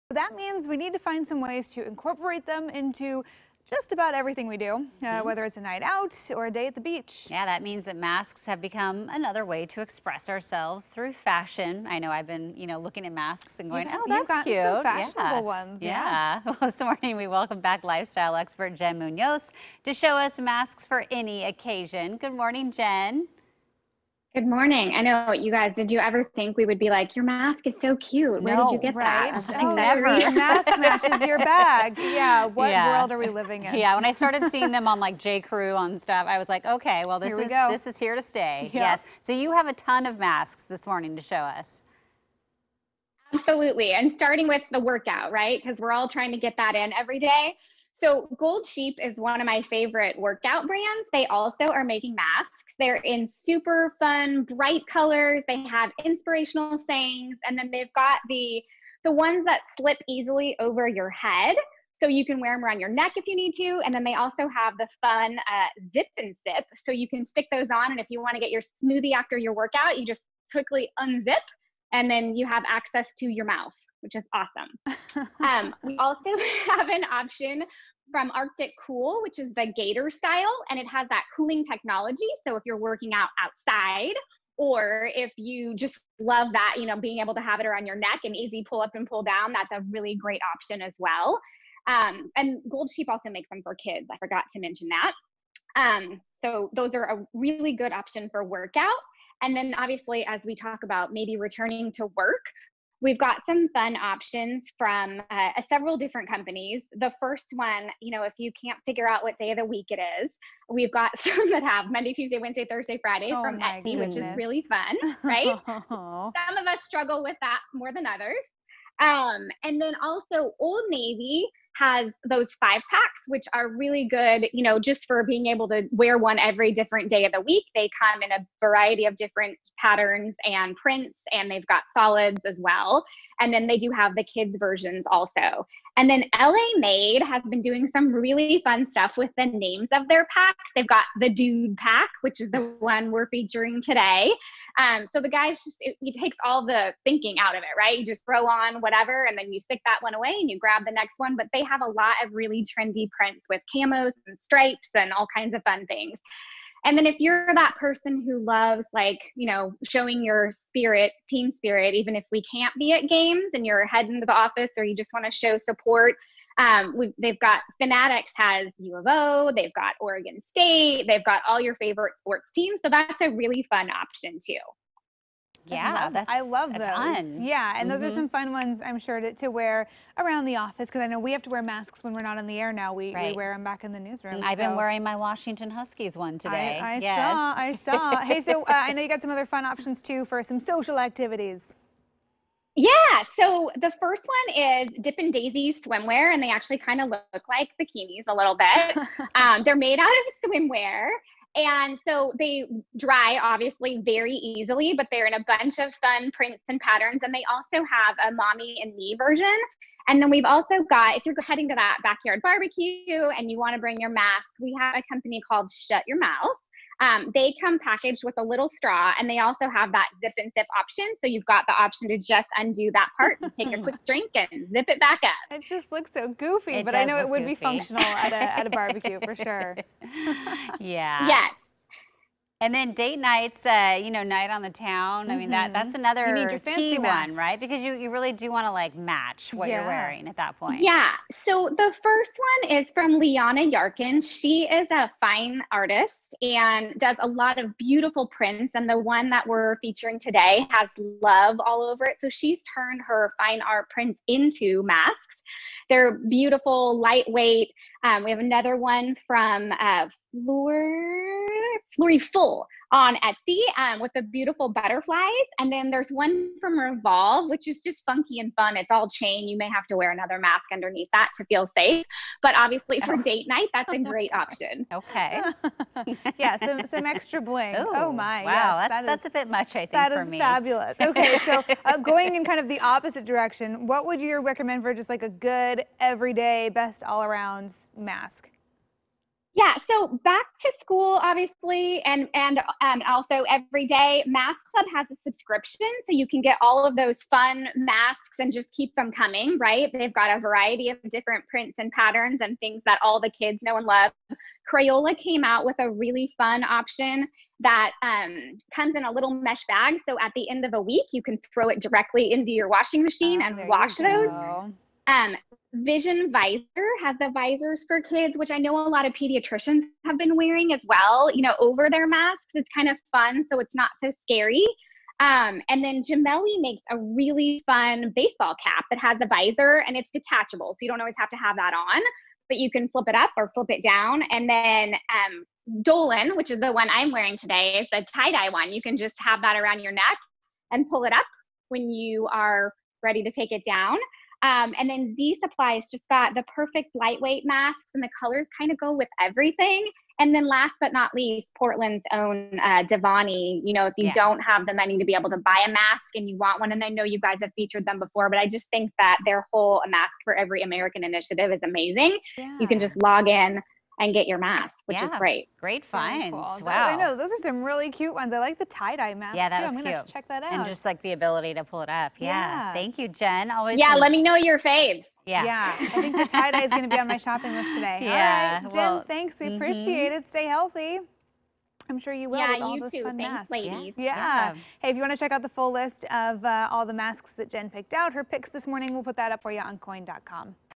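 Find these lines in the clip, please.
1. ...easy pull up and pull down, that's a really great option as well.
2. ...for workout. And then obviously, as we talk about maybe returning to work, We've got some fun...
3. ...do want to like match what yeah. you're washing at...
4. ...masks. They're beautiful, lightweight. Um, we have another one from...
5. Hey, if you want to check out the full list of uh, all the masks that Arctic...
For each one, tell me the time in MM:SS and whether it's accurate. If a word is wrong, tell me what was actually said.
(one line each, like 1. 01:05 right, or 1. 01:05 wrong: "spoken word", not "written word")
1. 01:28 right
2. 01:38 right
3. 03:58 wrong: "wearing", not "washing"
4. 04:14 right
5. 06:24 wrong: "Jen", not "Arctic".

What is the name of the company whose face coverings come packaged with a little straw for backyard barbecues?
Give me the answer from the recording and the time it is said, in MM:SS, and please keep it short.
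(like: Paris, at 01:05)
Shut Your Mouth, at 03:35.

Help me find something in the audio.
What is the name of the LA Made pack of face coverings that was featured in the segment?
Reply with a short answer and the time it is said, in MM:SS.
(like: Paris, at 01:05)
Dude Pack, at 02:21.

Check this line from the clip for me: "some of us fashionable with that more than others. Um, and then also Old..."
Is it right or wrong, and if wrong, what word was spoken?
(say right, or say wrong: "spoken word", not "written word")
wrong: "struggle", not "fashionable".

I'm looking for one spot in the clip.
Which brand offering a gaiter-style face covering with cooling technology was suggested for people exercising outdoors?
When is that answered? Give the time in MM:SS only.
01:18.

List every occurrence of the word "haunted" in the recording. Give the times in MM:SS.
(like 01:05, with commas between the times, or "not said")
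not said.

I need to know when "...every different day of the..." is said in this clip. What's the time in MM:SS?
02:06.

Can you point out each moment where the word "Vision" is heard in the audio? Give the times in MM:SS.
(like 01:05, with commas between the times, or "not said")
05:15.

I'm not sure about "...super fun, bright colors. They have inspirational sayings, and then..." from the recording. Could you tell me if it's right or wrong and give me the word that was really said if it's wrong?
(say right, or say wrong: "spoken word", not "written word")
right.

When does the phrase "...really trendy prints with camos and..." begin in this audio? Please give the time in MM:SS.
02:32.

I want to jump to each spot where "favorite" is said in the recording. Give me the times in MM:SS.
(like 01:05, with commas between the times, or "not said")
00:49, 02:51.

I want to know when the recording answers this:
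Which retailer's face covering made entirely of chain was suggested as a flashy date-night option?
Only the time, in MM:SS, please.
04:26.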